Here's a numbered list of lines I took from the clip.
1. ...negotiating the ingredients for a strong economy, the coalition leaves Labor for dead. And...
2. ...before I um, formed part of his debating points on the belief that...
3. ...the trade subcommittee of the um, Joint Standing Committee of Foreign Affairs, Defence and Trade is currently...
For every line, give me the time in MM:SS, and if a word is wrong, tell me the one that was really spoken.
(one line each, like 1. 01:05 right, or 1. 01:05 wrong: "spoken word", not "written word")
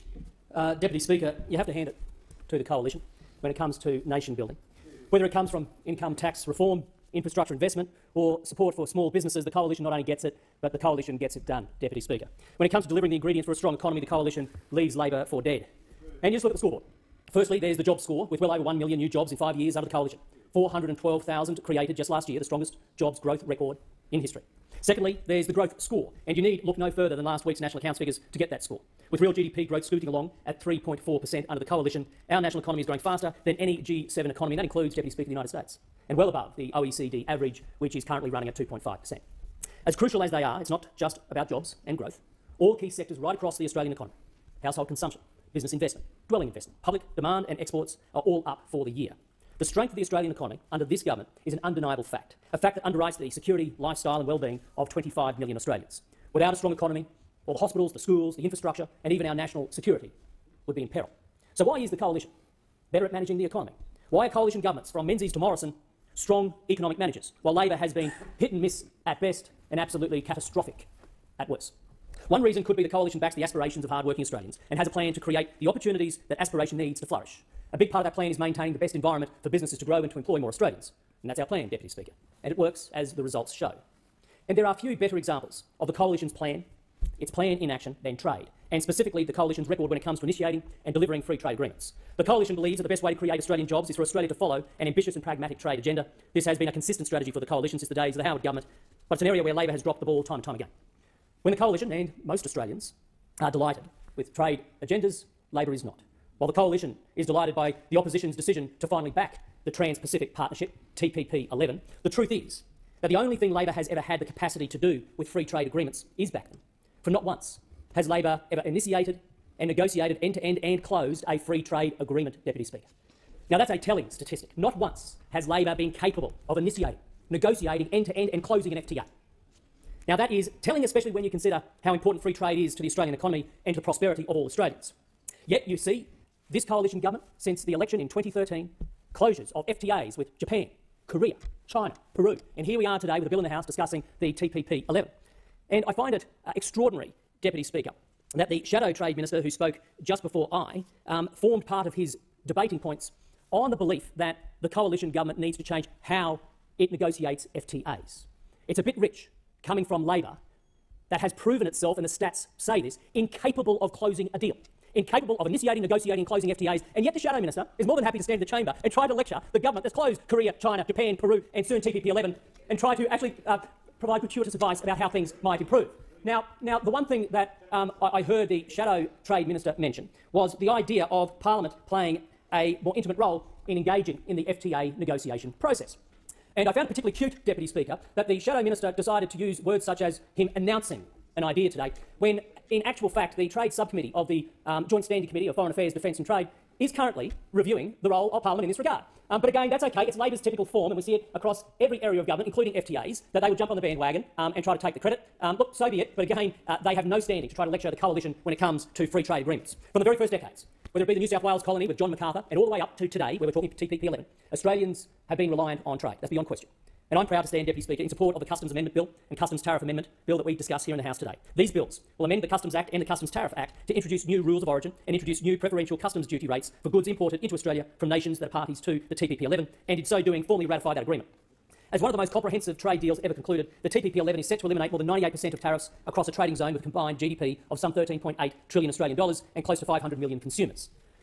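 1. 00:12 wrong: "delivering", not "negotiating"
2. 02:30 right
3. 03:13 right.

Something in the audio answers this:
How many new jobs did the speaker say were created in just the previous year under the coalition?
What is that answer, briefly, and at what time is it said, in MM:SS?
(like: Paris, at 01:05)
412,000, at 00:20.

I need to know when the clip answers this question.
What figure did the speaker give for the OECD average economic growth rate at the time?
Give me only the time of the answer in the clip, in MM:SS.
00:38.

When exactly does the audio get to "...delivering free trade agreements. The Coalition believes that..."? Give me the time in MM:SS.
01:30.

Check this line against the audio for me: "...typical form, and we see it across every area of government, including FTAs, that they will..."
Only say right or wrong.
right.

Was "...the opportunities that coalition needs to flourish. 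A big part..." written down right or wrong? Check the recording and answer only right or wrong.
wrong.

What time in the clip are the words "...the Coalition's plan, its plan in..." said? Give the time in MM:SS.
01:25.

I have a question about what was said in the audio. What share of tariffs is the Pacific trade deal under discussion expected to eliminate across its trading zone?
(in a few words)
More than 98%.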